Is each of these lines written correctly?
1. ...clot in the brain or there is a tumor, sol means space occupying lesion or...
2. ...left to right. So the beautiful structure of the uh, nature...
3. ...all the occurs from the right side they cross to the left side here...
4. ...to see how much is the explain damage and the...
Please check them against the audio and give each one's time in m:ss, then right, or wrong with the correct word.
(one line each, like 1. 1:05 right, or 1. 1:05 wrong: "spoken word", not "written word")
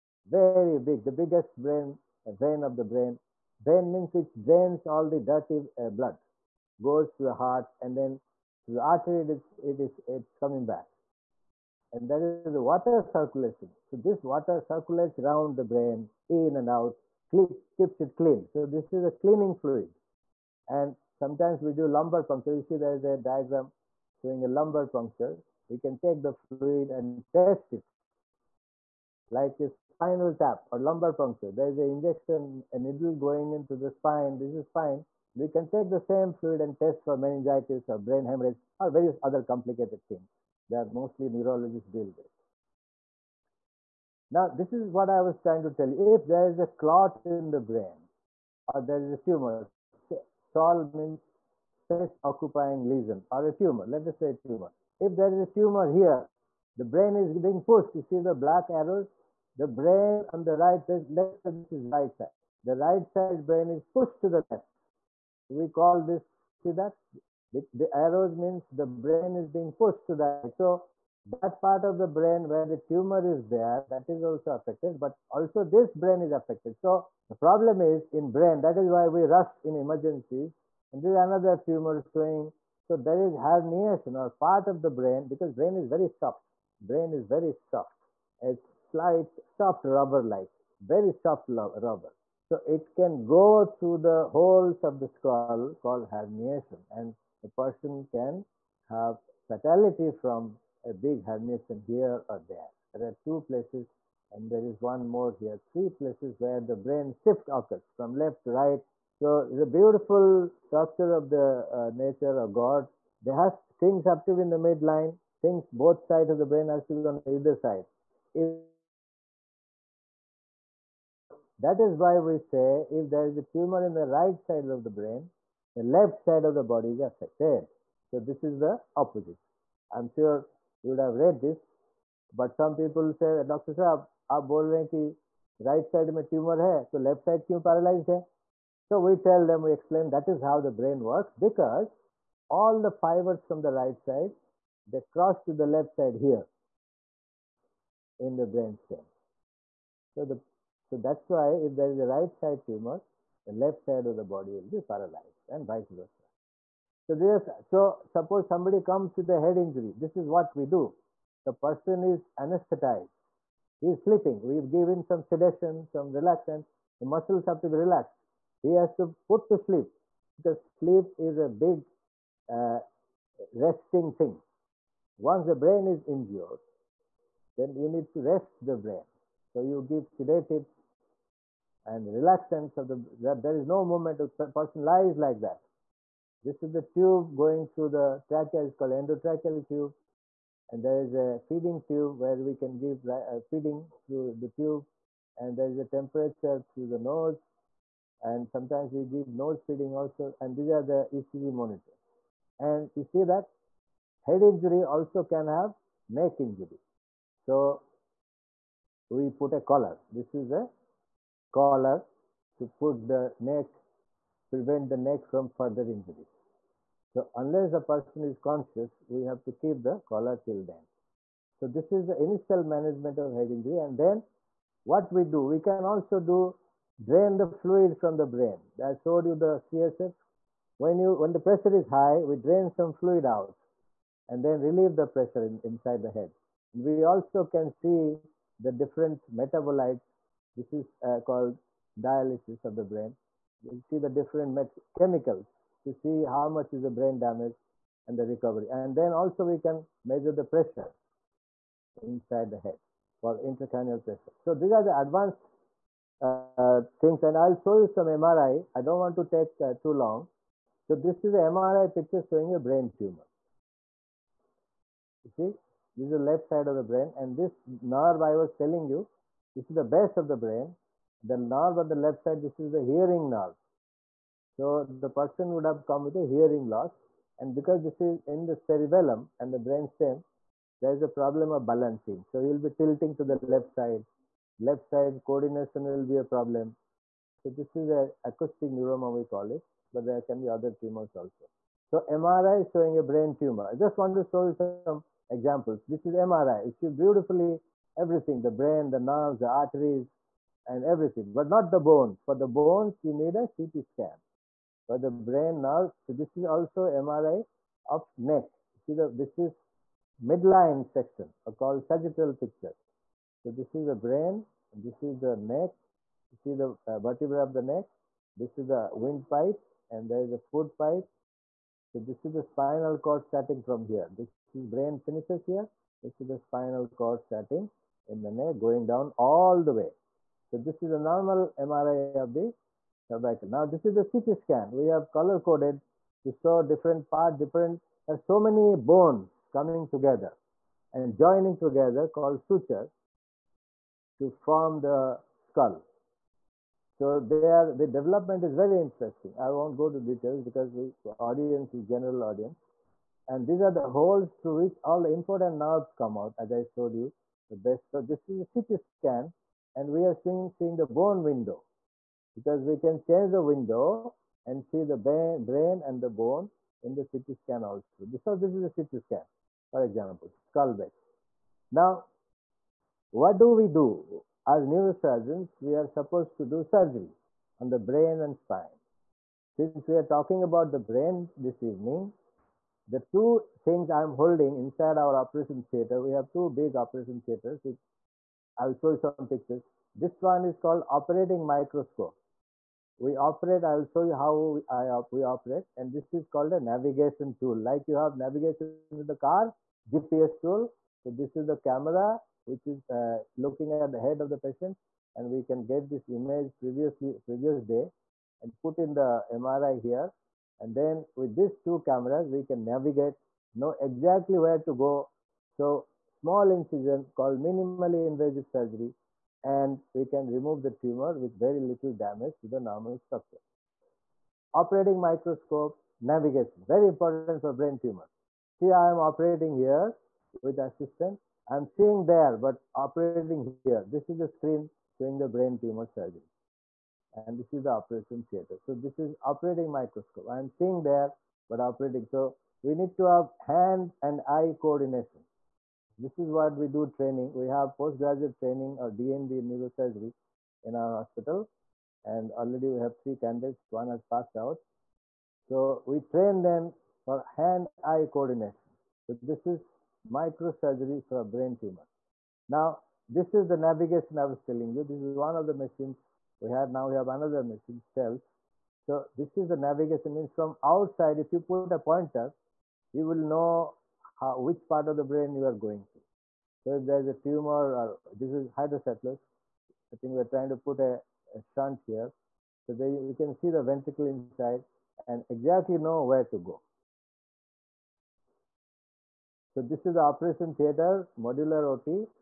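1. 0:46 right
2. 1:48 right
3. 2:22 wrong: "fibers", not "occurs"
4. 4:05 wrong: "brain", not "explain".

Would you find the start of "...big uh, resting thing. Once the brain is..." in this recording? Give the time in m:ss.
2:51.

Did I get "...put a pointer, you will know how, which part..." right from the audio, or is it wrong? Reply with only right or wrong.
right.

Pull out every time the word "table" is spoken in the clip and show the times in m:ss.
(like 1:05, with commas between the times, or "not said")
not said.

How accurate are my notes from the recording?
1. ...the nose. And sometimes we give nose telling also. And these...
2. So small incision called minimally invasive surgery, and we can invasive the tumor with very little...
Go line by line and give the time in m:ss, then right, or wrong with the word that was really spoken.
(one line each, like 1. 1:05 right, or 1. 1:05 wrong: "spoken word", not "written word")
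1. 3:16 wrong: "feeding", not "telling"
2. 6:55 wrong: "remove", not "invasive".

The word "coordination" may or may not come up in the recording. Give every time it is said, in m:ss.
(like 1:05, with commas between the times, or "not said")
4:45, 7:24, 7:38.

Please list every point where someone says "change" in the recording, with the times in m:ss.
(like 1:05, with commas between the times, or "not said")
6:03.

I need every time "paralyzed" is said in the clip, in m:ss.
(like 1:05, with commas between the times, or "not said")
2:17, 2:34.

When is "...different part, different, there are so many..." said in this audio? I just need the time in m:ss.
5:36.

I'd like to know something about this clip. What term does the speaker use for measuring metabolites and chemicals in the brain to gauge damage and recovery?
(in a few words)
dialysis of the brain.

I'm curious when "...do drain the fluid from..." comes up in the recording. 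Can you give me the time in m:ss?
3:46.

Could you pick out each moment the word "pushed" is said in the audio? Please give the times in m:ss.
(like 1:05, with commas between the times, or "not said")
0:57, 1:03, 1:09.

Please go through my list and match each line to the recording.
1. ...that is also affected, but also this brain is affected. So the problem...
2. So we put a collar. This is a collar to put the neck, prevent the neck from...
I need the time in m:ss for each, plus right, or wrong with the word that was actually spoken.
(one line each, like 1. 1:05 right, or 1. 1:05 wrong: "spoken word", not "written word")
1. 1:13 right
2. 3:27 right.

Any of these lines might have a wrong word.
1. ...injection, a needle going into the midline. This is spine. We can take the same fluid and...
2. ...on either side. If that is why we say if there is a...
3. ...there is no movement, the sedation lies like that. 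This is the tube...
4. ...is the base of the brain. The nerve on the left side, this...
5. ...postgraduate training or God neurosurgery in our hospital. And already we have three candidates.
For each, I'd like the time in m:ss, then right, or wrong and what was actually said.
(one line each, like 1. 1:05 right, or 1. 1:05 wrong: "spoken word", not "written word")
1. 0:31 wrong: "spine", not "midline"
2. 1:57 right
3. 3:03 wrong: "person", not "sedation"
4. 4:29 right
5. 7:27 wrong: "DNB", not "God".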